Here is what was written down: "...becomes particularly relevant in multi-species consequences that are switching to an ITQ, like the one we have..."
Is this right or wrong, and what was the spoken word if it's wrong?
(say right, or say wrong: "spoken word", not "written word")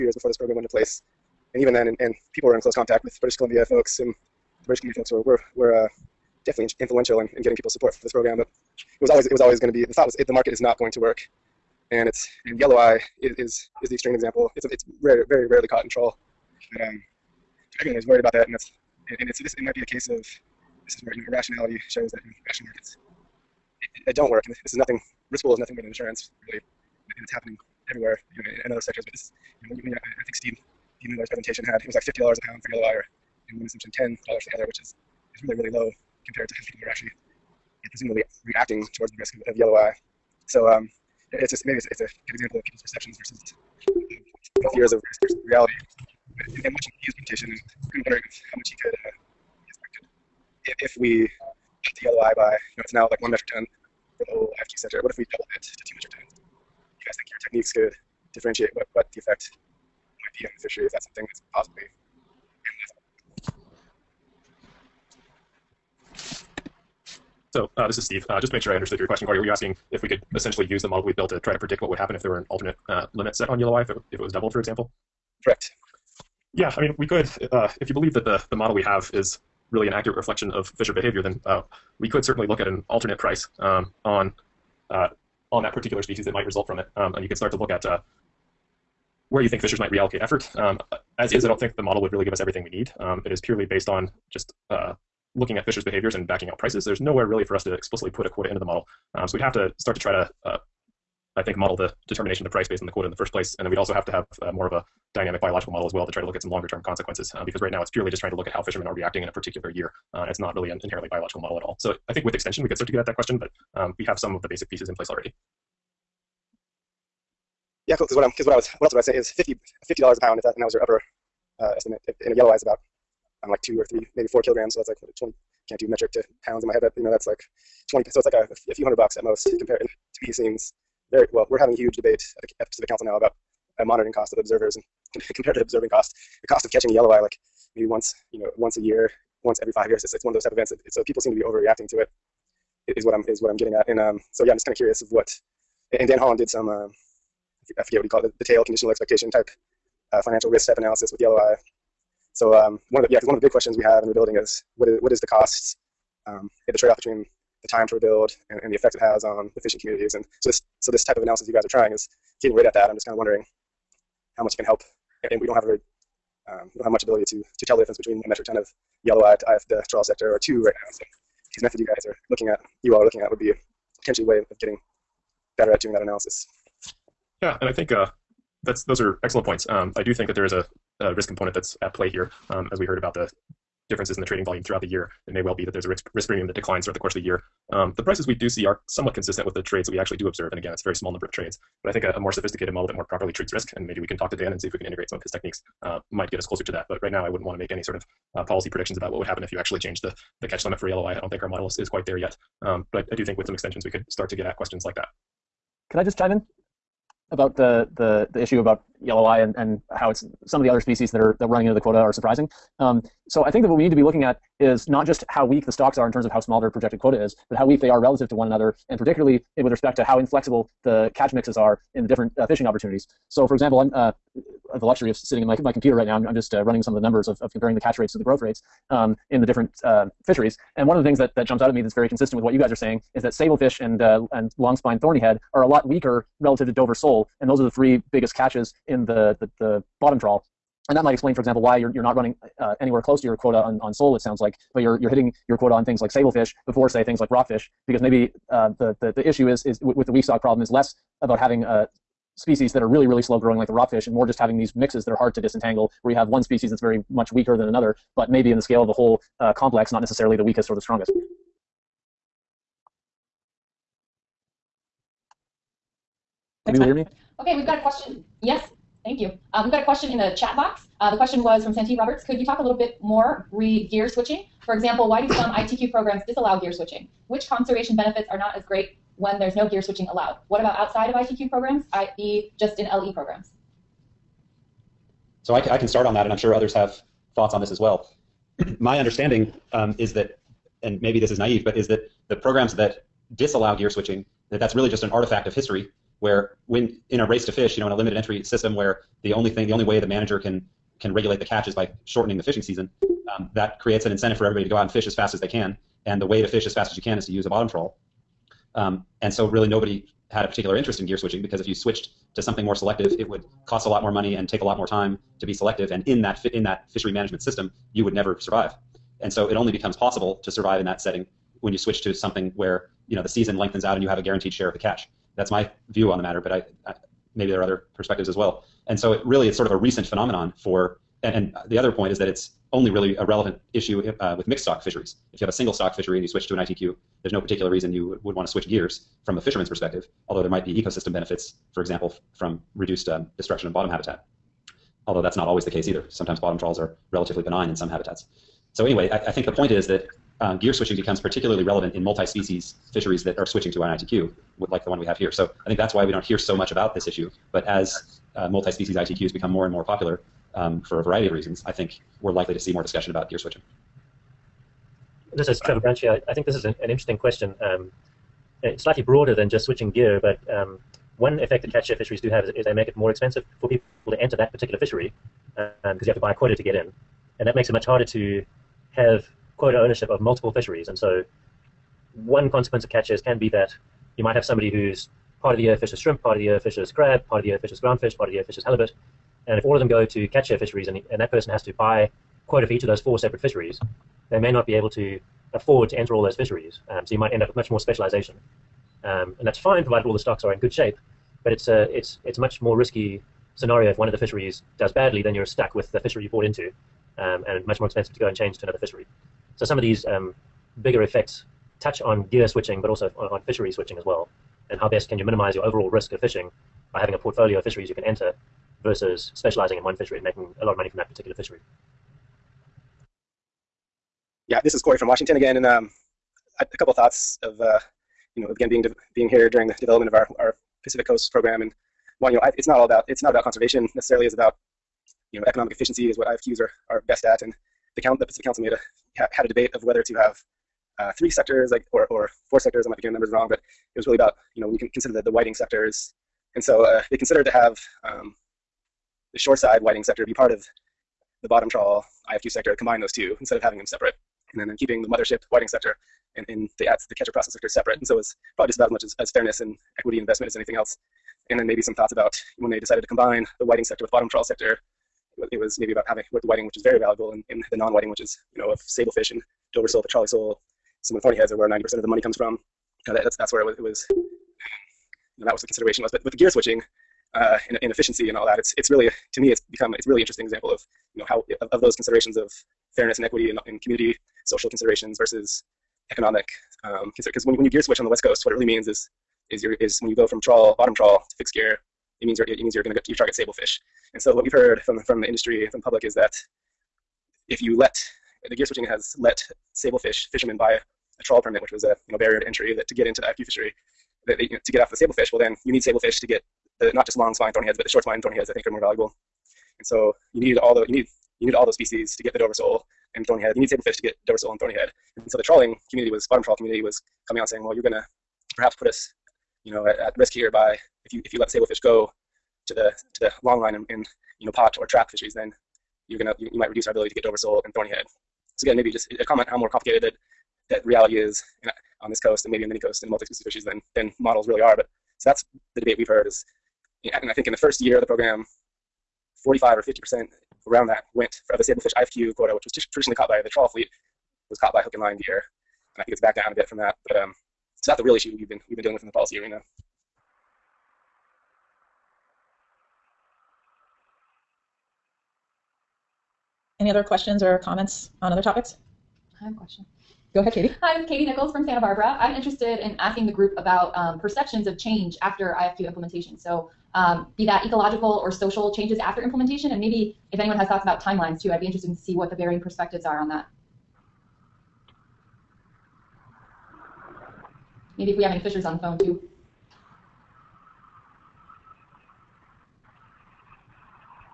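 wrong: "fisheries", not "consequences".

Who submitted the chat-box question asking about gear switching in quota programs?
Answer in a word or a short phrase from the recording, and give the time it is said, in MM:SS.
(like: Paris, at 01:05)
Santee Roberts, at 04:31.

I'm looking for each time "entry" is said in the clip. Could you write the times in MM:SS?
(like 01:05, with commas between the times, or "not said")
04:58, 08:22.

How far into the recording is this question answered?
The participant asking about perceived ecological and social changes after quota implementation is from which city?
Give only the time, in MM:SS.
09:21.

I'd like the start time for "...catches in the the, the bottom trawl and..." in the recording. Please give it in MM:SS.
03:58.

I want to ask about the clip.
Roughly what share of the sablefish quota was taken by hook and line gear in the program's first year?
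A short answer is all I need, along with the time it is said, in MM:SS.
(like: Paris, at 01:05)
45 or 50 percent, at 08:59.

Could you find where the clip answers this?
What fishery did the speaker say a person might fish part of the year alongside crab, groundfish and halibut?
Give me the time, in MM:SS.
06:25.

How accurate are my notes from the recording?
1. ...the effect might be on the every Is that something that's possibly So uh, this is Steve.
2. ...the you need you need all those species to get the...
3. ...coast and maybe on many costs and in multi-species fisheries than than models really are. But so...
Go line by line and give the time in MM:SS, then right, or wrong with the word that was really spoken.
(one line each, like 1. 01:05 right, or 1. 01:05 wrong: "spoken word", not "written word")
1. 00:59 wrong: "fishery", not "every"
2. 08:30 right
3. 08:52 wrong: "coasts", not "costs".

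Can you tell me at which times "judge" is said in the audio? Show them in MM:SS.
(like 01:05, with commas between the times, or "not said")
not said.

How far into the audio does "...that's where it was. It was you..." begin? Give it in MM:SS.
07:53.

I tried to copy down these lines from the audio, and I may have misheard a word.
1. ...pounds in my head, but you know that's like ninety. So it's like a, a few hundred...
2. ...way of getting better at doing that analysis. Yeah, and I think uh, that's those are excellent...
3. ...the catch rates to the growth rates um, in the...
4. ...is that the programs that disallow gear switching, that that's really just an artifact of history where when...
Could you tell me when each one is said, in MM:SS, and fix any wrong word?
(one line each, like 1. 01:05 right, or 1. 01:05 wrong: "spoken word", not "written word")
1. 02:06 wrong: "twenty", not "ninety"
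2. 02:54 right
3. 03:47 right
4. 04:51 right.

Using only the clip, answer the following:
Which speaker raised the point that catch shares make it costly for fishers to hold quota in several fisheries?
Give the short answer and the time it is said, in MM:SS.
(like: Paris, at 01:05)
Trevor Branch, at 06:05.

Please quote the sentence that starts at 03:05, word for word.
It may well be that there's a risk risk premium that declines throughout the course of the year.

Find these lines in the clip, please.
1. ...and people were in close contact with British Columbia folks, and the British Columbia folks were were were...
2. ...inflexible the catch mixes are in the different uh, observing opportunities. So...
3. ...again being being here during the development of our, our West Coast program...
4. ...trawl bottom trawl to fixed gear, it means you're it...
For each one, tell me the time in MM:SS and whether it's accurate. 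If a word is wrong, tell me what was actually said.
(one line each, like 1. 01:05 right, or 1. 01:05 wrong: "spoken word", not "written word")
1. 00:01 right
2. 03:40 wrong: "fishing", not "observing"
3. 07:08 wrong: "Pacific", not "West"
4. 08:10 right.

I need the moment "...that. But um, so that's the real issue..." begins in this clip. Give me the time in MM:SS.
09:06.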